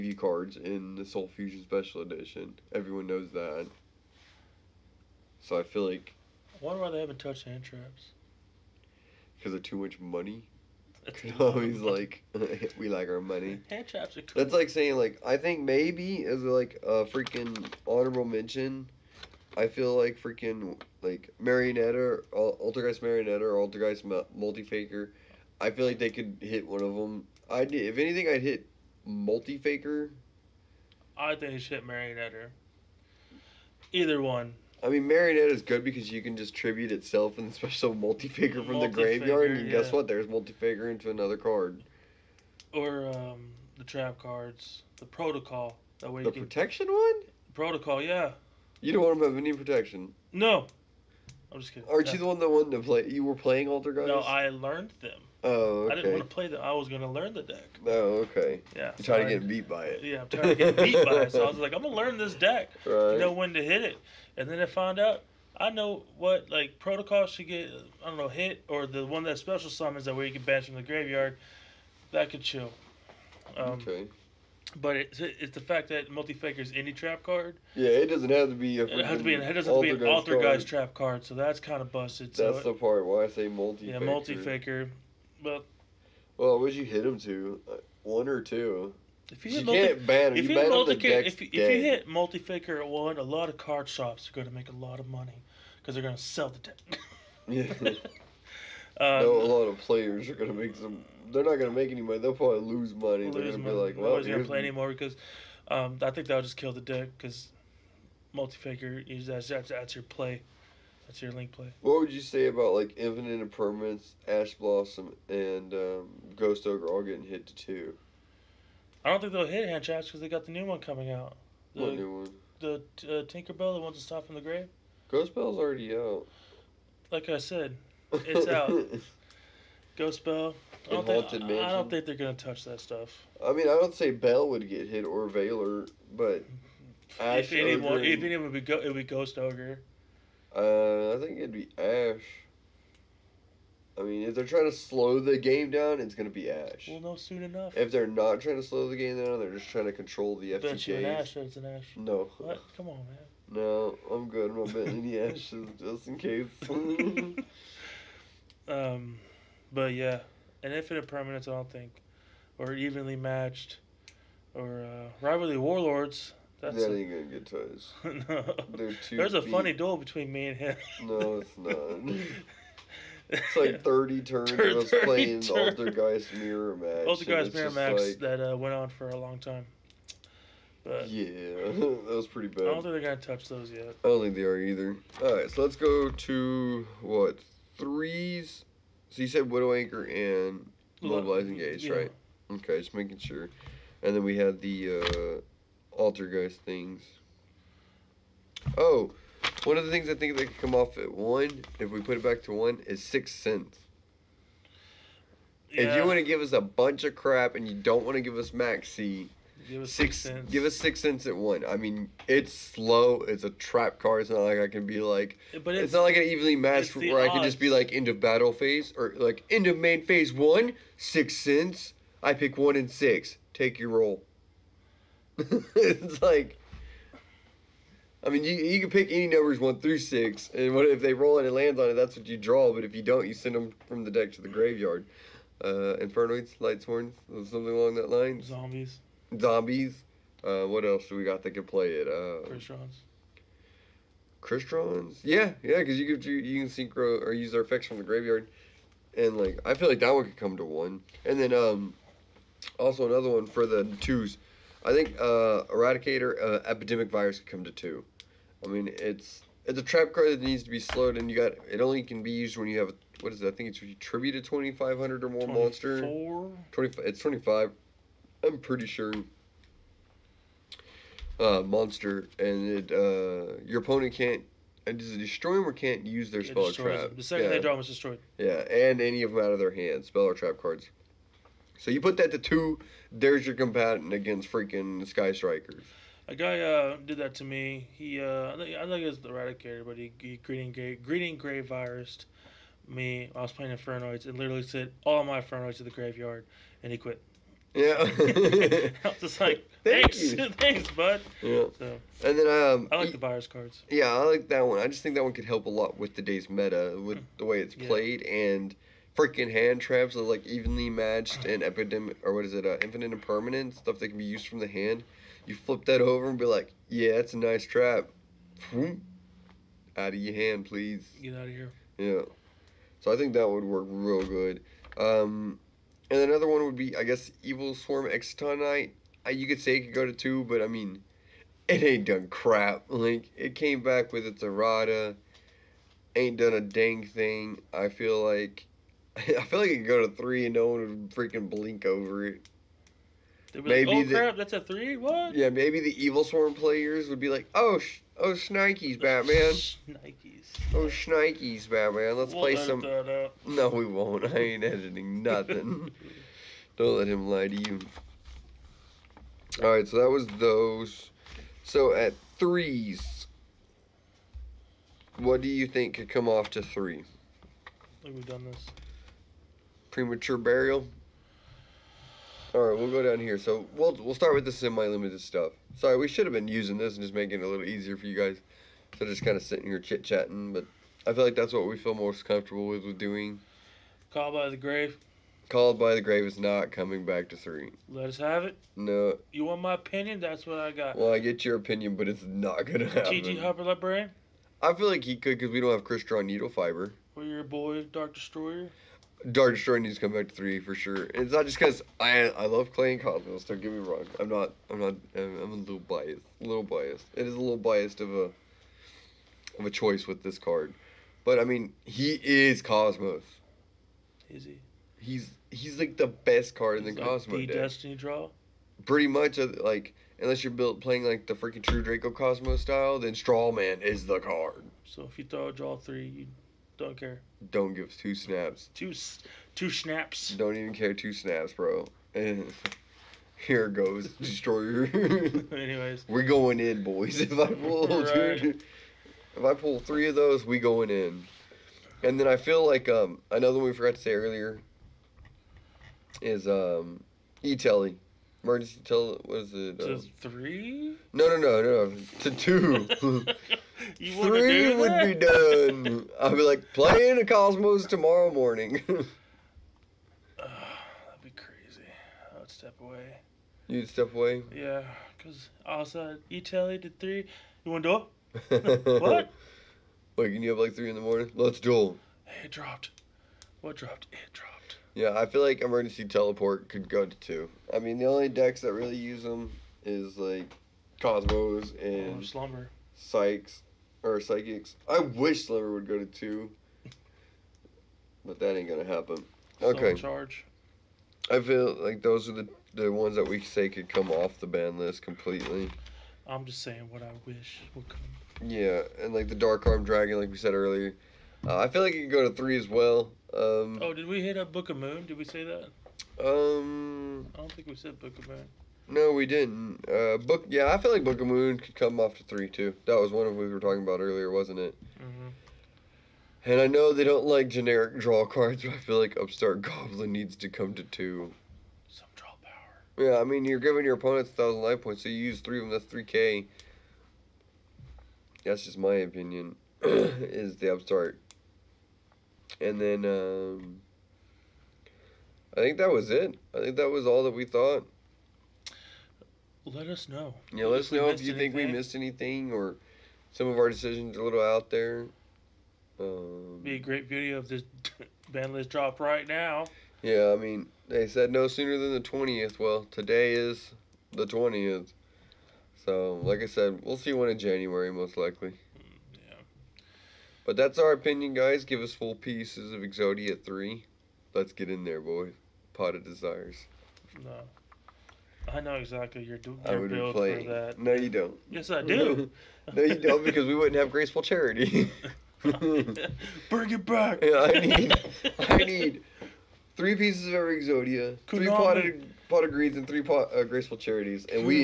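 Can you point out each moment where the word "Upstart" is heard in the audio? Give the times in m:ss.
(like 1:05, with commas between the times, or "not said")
8:39, 8:50.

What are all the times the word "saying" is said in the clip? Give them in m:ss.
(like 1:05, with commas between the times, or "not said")
0:14, 8:16.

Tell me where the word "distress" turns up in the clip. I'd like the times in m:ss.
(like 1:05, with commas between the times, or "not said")
not said.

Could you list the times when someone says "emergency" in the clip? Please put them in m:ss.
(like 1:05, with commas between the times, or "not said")
7:28, 7:55.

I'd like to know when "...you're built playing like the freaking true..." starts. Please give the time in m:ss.
7:00.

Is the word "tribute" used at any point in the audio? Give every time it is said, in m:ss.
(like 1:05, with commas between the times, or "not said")
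0:36, 4:23.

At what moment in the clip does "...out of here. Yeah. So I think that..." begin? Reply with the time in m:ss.
5:21.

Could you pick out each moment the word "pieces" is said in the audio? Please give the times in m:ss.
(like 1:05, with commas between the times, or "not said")
9:22, 9:39.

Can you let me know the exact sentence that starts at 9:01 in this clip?
think we missed anything or some of our decisions are a little out there.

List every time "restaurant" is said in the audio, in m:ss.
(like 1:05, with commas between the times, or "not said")
not said.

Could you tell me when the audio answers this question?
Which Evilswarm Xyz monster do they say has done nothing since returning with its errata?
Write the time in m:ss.
5:27.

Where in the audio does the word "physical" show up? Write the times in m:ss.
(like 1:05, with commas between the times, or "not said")
not said.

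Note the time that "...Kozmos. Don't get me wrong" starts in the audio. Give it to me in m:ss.
6:43.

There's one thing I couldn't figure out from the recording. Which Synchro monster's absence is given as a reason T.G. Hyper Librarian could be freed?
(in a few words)
Crystron Needlefiber.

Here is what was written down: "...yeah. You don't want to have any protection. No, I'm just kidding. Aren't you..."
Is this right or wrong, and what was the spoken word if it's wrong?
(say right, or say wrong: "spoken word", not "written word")
right.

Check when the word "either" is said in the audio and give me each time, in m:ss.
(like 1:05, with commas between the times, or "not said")
0:33, 3:04.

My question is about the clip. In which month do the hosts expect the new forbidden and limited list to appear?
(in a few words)
January.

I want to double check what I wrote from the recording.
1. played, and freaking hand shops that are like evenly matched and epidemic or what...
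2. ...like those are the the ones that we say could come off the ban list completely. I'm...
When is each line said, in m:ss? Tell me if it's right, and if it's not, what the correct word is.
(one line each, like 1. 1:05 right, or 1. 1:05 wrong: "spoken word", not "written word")
1. 5:07 wrong: "traps", not "shops"
2. 8:11 right.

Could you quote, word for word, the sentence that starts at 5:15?
You flip that over and be like, yeah, that's a nice trap.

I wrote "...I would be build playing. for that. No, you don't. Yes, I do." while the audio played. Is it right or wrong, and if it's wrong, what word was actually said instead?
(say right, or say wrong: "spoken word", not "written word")
right.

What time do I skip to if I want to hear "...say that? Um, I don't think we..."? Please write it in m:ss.
8:25.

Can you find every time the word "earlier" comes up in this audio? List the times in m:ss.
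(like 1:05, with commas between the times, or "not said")
7:24, 8:20, 8:33.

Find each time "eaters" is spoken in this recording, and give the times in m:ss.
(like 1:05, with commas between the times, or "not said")
not said.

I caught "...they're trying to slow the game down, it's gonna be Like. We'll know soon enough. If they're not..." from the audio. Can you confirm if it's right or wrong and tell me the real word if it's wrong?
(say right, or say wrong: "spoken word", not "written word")
wrong: "Ash", not "Like".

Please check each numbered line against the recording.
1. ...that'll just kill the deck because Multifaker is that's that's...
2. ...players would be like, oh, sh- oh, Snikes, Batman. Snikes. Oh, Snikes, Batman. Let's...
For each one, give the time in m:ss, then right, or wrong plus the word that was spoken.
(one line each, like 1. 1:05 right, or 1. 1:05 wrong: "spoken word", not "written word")
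1. 1:46 right
2. 5:46 right.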